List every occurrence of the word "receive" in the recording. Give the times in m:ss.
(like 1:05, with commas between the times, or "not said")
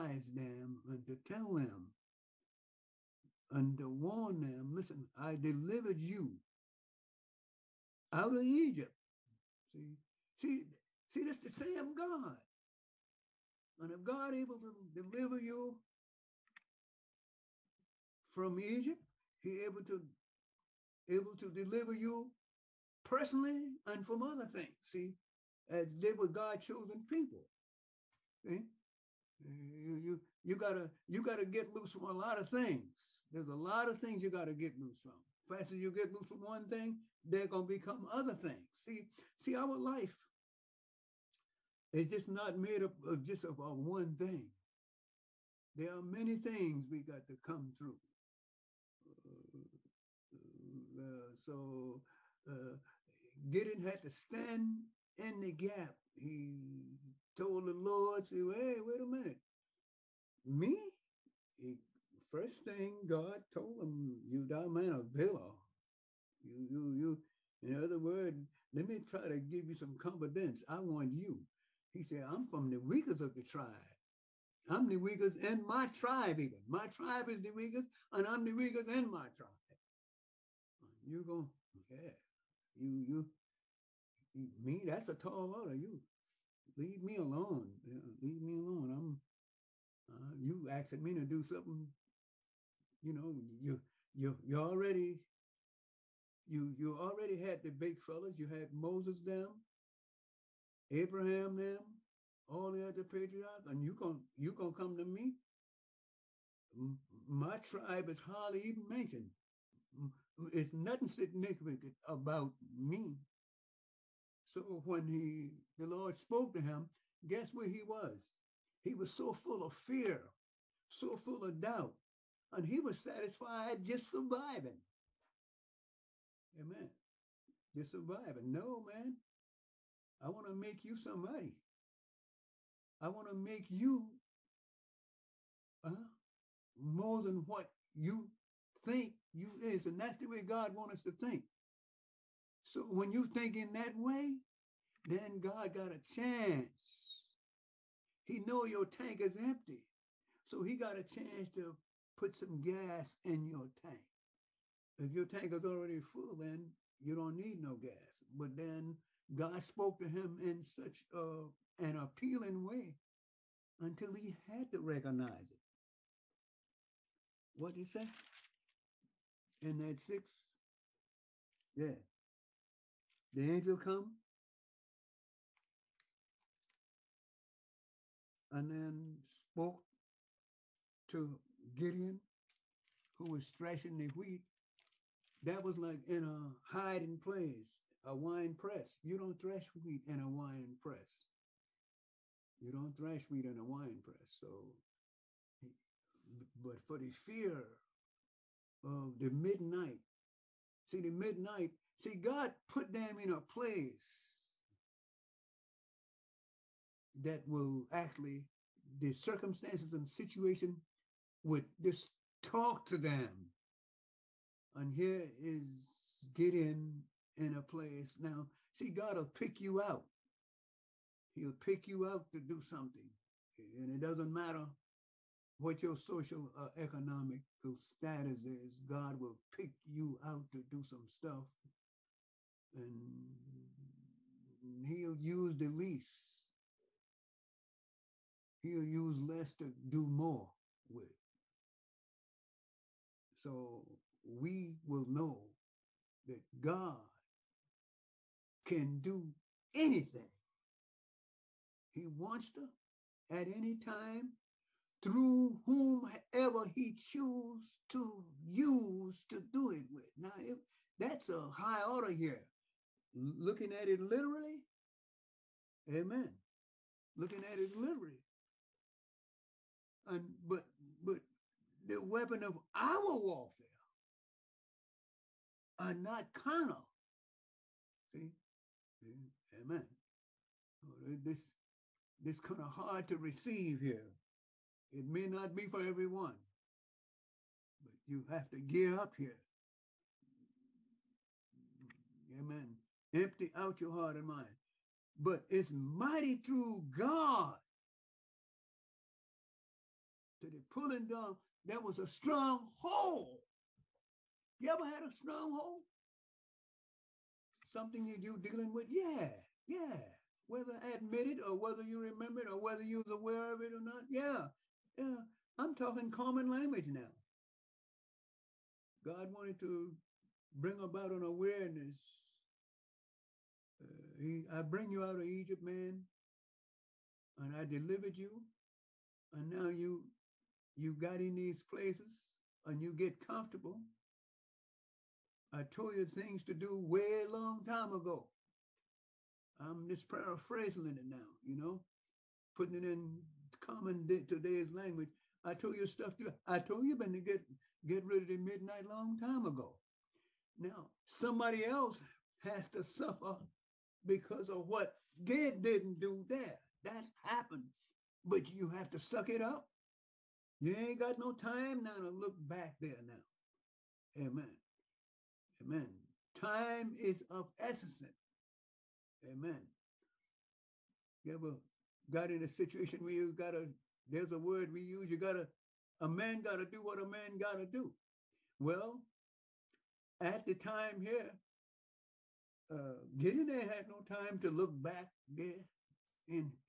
4:43.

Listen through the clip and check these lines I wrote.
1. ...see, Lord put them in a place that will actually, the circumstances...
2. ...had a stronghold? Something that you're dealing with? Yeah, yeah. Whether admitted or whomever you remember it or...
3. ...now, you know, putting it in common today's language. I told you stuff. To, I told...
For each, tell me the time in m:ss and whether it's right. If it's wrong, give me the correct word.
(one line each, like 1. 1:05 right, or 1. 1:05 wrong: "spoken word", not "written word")
1. 3:22 wrong: "God", not "Lord"
2. 5:04 wrong: "whether", not "whomever"
3. 5:41 right.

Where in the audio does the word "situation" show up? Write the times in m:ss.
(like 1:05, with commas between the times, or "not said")
3:30, 6:12.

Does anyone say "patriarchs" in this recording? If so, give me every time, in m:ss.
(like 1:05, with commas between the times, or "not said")
1:43.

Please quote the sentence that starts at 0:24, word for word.
See, as they were God chosen people.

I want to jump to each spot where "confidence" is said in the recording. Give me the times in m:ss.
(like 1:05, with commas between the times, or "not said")
1:09.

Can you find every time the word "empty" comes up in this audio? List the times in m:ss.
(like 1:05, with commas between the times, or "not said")
2:29, 4:53.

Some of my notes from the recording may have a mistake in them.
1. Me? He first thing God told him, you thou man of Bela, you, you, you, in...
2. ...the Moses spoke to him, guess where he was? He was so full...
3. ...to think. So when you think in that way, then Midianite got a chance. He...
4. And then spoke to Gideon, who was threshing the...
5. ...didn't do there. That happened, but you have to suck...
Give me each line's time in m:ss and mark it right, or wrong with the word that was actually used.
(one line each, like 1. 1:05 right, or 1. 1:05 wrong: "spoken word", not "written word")
1. 1:00 right
2. 1:55 wrong: "Lord", not "Moses"
3. 2:21 wrong: "God", not "Midianite"
4. 2:58 right
5. 5:55 right.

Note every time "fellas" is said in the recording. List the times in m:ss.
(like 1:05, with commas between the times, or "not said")
1:37.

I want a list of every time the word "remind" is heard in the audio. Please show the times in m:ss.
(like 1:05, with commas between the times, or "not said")
not said.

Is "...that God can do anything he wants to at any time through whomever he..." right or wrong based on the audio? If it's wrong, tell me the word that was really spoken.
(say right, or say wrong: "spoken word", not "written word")
right.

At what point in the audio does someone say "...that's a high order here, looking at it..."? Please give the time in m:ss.
4:20.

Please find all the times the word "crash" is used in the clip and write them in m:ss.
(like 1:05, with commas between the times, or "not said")
not said.